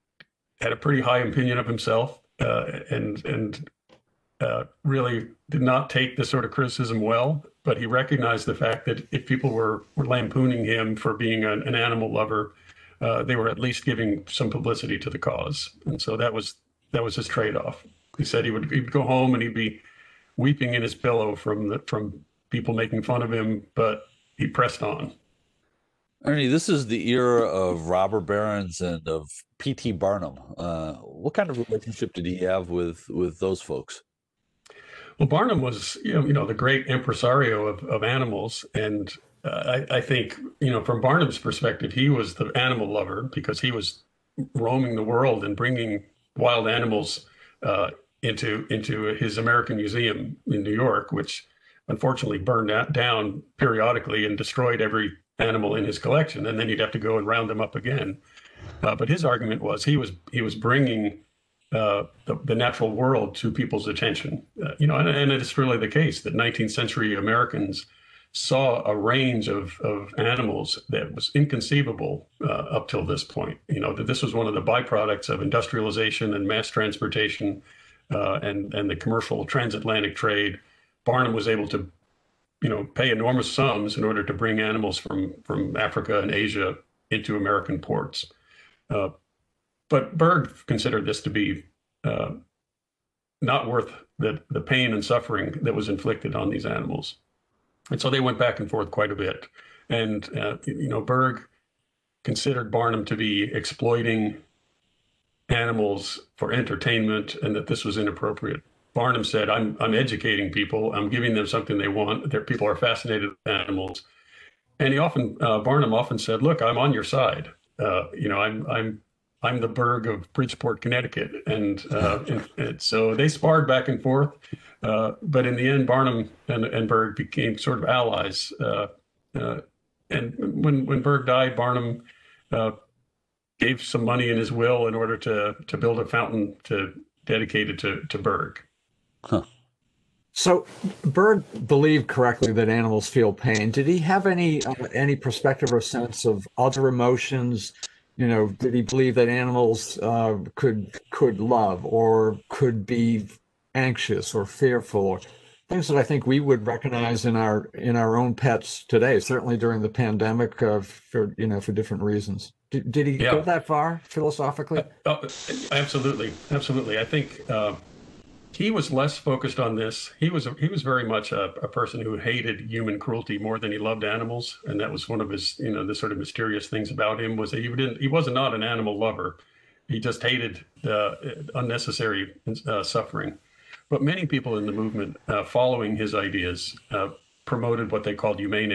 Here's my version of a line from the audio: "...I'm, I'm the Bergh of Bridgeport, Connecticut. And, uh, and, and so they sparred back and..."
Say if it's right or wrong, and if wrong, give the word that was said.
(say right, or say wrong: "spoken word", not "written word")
right.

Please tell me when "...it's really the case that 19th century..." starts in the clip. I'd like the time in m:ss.
1:05.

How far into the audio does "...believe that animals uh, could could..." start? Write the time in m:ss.
2:28.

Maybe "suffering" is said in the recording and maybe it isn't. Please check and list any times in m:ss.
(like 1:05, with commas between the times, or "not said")
1:35, 3:02.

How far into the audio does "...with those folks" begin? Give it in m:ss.
0:33.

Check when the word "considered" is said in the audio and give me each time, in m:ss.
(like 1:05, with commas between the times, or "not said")
1:30, 1:42.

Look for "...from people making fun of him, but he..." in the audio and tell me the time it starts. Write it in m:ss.
0:21.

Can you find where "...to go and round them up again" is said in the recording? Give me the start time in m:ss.
0:56.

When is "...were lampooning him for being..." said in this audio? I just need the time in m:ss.
0:09.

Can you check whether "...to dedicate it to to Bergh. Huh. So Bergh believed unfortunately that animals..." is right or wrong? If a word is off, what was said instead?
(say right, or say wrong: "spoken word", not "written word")
wrong: "correctly", not "unfortunately".